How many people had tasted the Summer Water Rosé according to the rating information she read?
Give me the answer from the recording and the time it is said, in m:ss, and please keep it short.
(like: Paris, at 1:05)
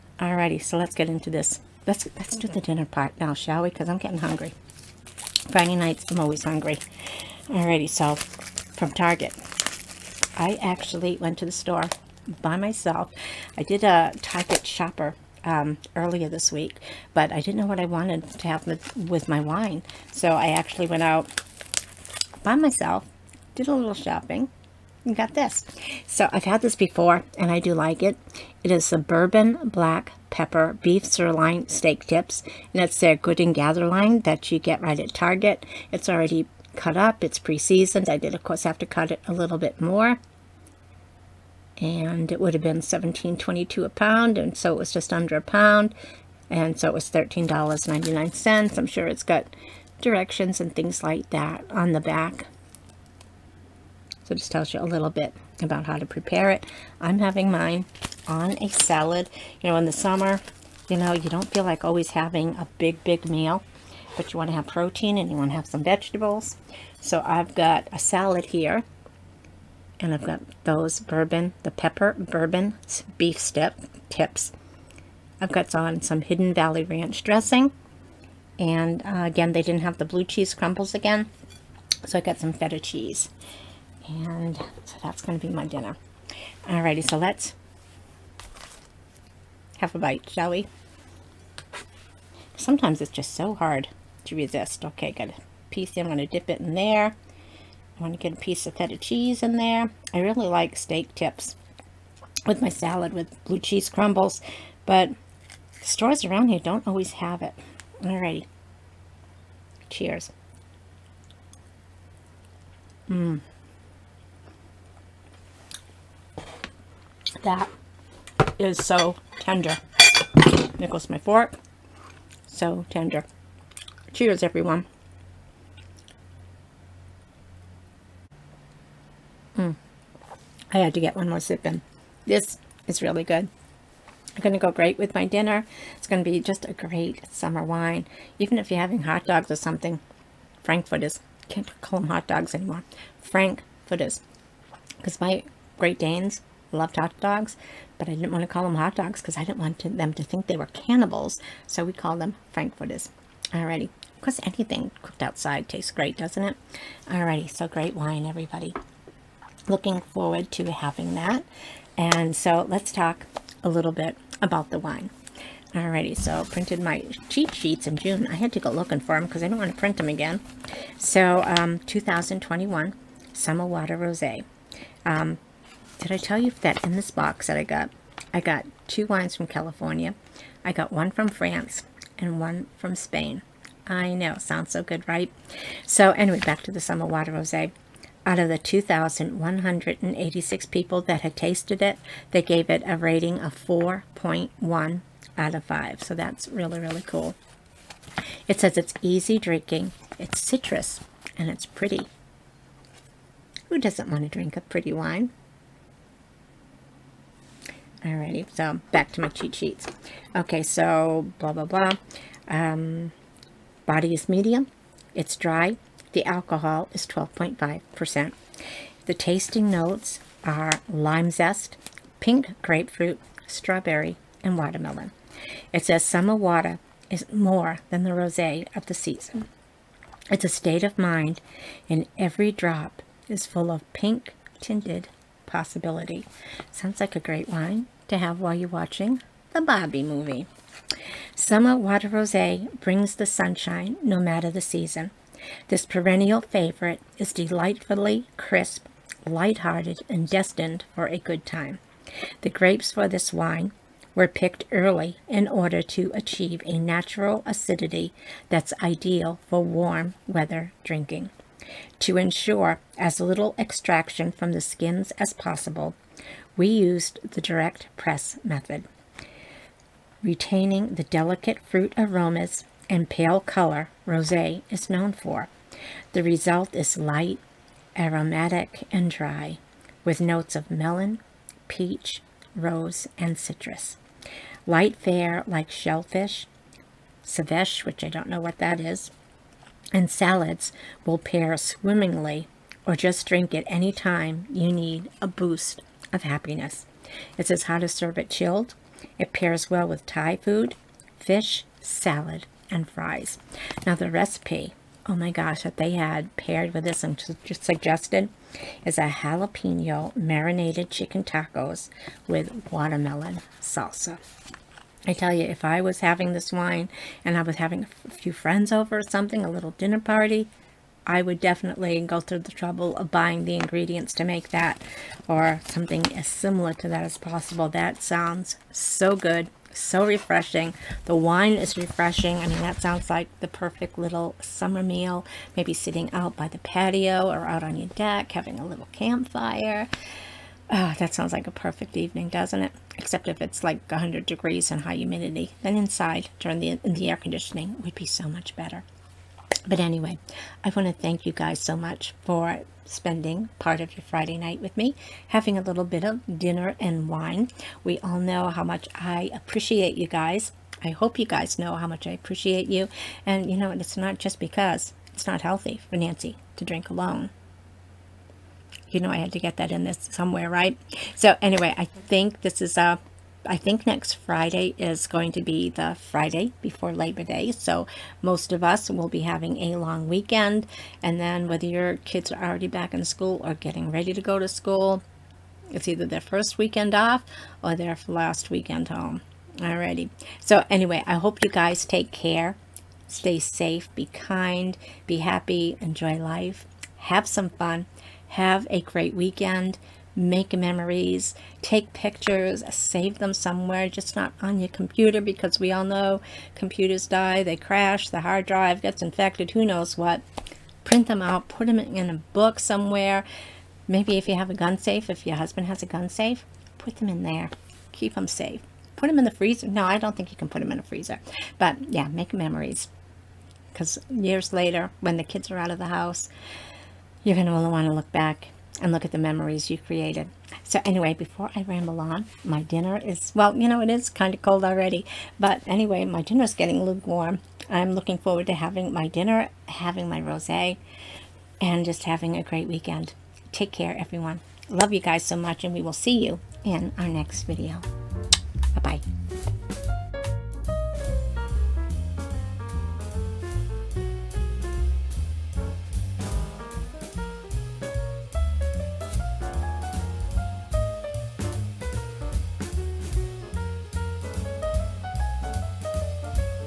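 2,186, at 3:08.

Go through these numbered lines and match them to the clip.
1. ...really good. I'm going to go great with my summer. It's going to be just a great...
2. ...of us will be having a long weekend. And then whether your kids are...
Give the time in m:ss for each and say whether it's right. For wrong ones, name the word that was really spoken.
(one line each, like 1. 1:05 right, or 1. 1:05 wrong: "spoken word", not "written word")
1. 2:13 wrong: "dinner", not "summer"
2. 6:18 right.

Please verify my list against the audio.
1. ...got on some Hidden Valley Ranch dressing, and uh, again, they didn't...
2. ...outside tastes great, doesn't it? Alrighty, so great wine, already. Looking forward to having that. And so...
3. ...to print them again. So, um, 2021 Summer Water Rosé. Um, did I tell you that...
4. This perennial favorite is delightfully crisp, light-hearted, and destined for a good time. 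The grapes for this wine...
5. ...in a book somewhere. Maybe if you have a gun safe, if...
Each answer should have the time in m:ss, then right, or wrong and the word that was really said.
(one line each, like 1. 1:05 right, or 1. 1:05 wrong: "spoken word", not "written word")
1. 1:15 right
2. 2:35 wrong: "everybody", not "already"
3. 2:49 right
4. 4:05 right
5. 6:51 right.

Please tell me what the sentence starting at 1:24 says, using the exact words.
And so that's going to be my dinner.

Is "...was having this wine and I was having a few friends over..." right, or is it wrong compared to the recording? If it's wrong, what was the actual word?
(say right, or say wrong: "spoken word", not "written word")
right.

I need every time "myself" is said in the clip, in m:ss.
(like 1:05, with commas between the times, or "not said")
0:12, 0:22.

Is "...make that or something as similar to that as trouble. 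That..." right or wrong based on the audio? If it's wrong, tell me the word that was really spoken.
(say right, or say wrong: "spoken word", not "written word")
wrong: "possible", not "trouble".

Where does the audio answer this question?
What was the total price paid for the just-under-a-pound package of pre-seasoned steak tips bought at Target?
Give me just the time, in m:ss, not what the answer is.
0:47.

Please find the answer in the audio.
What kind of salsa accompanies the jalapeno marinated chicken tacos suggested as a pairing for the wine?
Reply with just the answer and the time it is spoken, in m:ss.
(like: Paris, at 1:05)
Watermelon salsa, at 5:12.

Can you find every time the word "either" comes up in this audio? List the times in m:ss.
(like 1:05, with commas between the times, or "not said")
6:25.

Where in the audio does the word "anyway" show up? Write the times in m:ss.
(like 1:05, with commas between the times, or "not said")
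3:06, 5:49, 6:11, 6:30, 7:10, 7:15.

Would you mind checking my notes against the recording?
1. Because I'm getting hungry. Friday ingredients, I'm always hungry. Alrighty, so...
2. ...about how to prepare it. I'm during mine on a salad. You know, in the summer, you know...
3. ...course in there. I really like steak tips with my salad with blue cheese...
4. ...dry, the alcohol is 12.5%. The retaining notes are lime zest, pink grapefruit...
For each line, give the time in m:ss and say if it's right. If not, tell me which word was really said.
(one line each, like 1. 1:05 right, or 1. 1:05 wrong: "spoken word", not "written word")
1. 0:03 wrong: "nights", not "ingredients"
2. 0:55 wrong: "having", not "during"
3. 1:38 wrong: "cheese", not "course"
4. 3:35 wrong: "tasting", not "retaining".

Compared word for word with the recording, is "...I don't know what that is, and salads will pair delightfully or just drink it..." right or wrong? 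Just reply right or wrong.
wrong.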